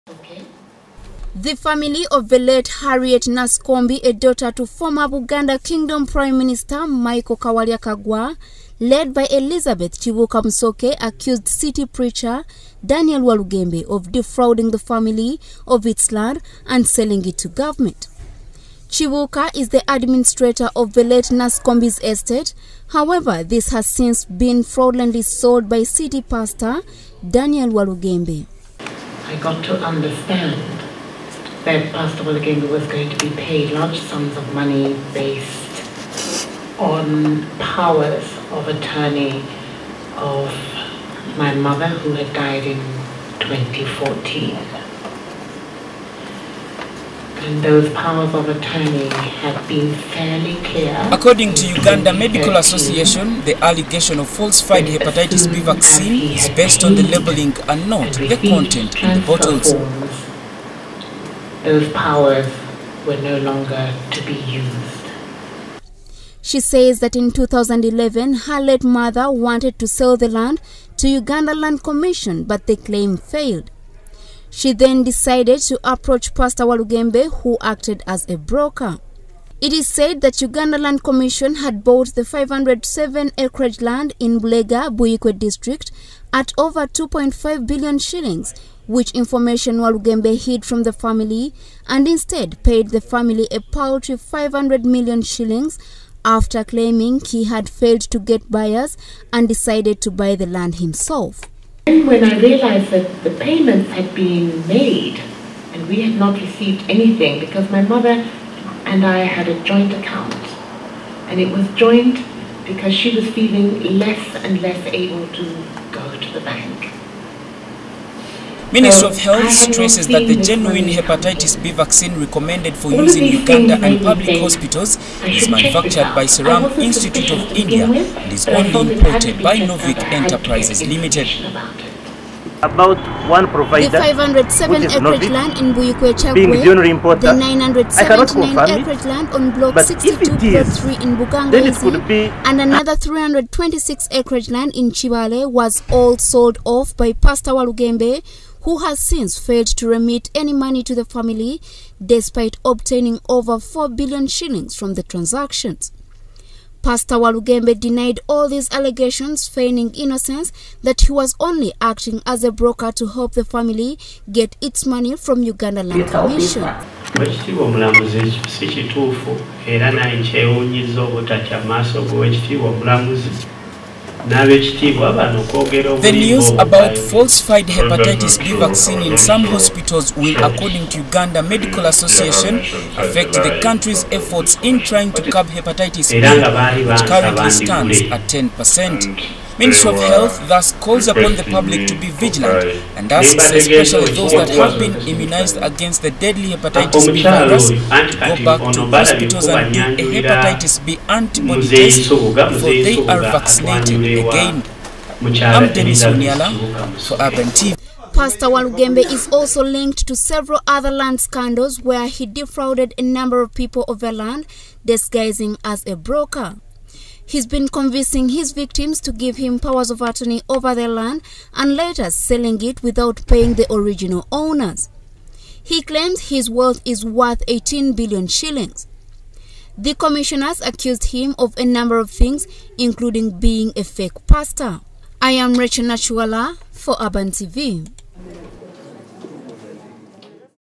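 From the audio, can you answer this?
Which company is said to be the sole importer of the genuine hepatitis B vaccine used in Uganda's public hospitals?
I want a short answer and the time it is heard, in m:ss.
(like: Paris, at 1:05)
Novik Enterprises Limited, at 2:09.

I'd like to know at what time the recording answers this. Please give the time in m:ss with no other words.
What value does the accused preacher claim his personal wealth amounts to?
3:47.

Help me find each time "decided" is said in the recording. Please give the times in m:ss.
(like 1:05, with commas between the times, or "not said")
1:15, 1:39.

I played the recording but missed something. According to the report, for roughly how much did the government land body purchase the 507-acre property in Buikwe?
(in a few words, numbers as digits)
over 2.5 billion shillings.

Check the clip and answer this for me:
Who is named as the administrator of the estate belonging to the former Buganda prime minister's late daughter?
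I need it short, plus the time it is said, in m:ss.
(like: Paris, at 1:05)
Elizabeth Chibuka Msoke, at 0:09.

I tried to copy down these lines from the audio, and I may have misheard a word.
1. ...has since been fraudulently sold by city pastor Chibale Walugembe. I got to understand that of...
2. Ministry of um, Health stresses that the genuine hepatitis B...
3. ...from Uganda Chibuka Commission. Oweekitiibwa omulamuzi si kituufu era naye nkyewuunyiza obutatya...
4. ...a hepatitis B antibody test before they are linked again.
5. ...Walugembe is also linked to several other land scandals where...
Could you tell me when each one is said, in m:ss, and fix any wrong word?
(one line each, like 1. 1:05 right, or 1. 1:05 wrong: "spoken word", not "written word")
1. 0:23 wrong: "Daniel", not "Chibale"
2. 1:58 right
3. 2:45 wrong: "Land", not "Chibuka"
4. 3:20 wrong: "vaccinated", not "linked"
5. 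3:28 right.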